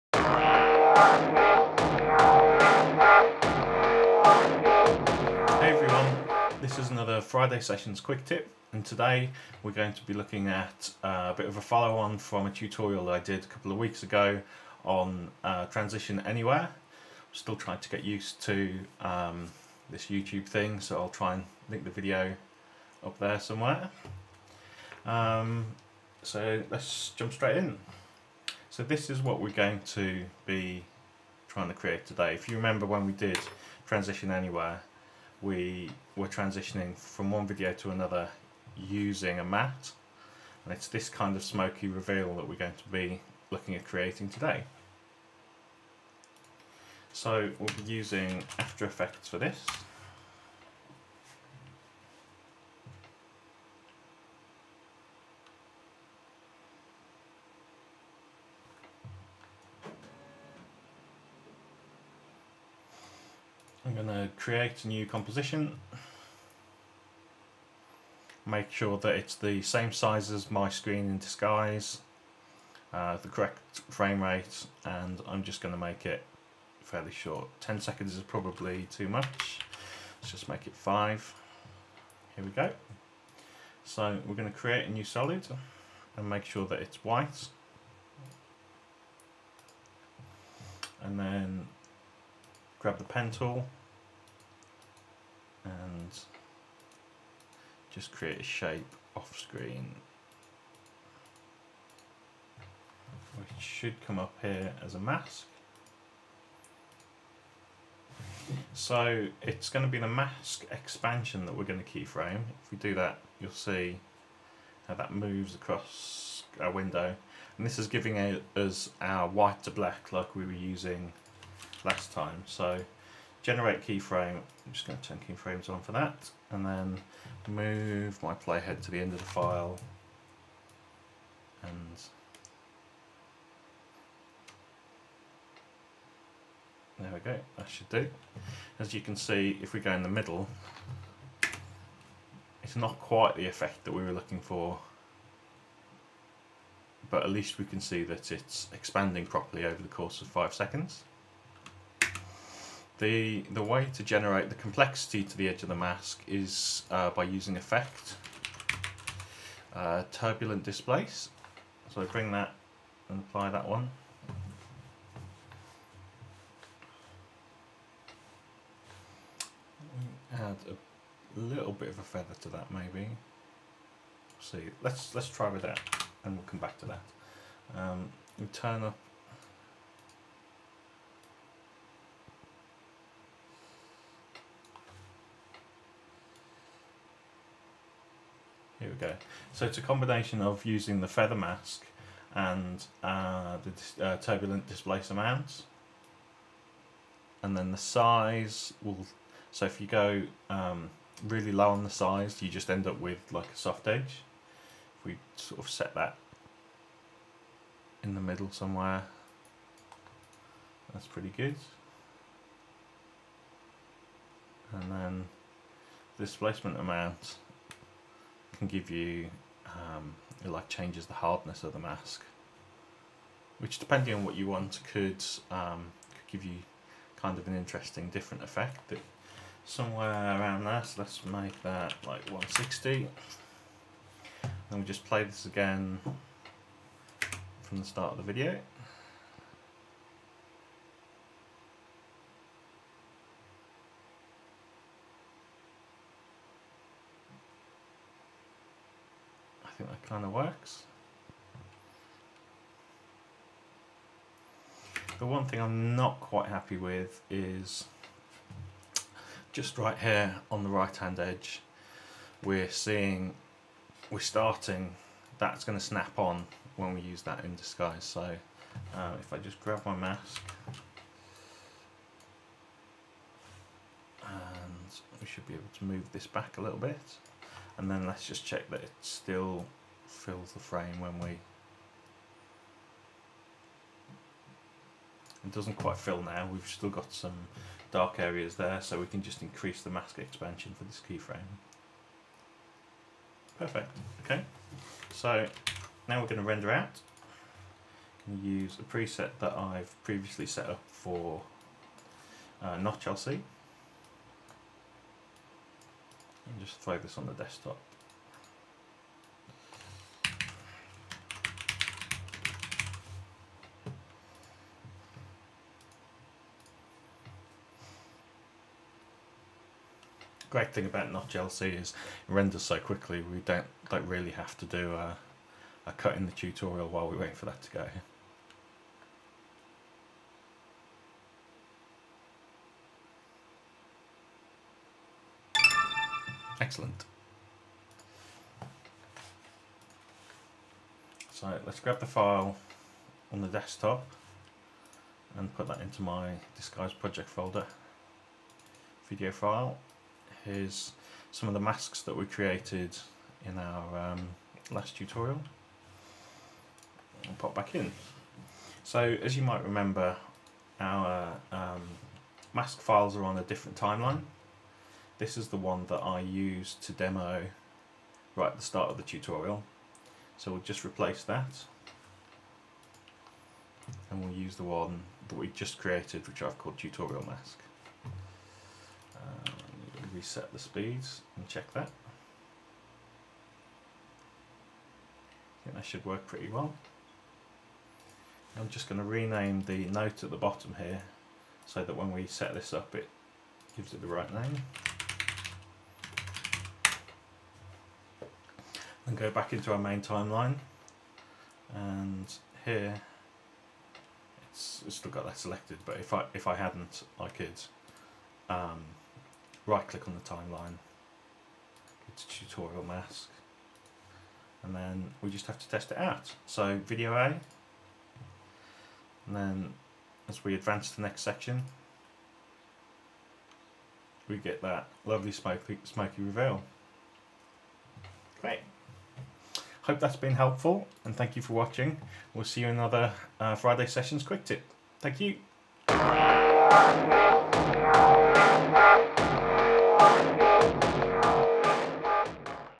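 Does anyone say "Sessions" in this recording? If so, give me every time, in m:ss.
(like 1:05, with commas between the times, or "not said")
0:07, 7:13.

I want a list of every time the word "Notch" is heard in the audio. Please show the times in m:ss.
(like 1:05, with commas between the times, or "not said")
5:02, 5:21.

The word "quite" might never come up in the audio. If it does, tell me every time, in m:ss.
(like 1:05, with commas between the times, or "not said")
2:22, 4:16, 4:45.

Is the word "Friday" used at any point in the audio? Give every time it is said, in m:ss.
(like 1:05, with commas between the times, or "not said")
0:07, 7:13.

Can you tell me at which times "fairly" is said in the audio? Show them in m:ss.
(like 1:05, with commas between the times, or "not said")
1:16.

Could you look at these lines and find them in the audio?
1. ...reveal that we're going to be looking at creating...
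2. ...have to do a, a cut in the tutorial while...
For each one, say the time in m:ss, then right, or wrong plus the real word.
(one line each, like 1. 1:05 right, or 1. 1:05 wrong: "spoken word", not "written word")
1. 0:41 right
2. 5:24 right.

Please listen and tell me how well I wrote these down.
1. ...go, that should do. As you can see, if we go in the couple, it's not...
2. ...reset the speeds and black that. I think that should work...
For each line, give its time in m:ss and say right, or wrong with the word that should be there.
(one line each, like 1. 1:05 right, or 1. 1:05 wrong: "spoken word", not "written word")
1. 2:17 wrong: "middle", not "couple"
2. 6:20 wrong: "check", not "black".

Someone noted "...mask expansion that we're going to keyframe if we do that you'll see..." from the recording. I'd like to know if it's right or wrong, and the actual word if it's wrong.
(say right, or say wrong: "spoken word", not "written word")
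right.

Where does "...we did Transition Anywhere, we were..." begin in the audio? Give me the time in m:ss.
0:33.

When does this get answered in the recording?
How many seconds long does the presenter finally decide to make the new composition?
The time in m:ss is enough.
1:20.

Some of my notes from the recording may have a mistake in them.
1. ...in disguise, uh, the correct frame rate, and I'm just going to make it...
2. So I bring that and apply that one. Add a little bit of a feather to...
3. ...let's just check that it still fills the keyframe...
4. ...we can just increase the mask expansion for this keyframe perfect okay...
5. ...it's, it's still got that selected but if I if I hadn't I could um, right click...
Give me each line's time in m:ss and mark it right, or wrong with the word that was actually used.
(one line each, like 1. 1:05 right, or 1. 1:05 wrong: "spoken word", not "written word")
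1. 1:11 right
2. 2:41 right
3. 4:38 wrong: "frame", not "keyframe"
4. 4:48 right
5. 6:44 right.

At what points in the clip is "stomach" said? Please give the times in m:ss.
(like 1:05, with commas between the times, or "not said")
not said.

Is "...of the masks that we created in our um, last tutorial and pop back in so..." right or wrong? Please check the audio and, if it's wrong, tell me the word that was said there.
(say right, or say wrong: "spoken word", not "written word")
right.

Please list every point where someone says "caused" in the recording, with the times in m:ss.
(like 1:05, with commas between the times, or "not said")
not said.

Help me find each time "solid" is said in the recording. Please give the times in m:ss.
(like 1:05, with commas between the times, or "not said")
1:25.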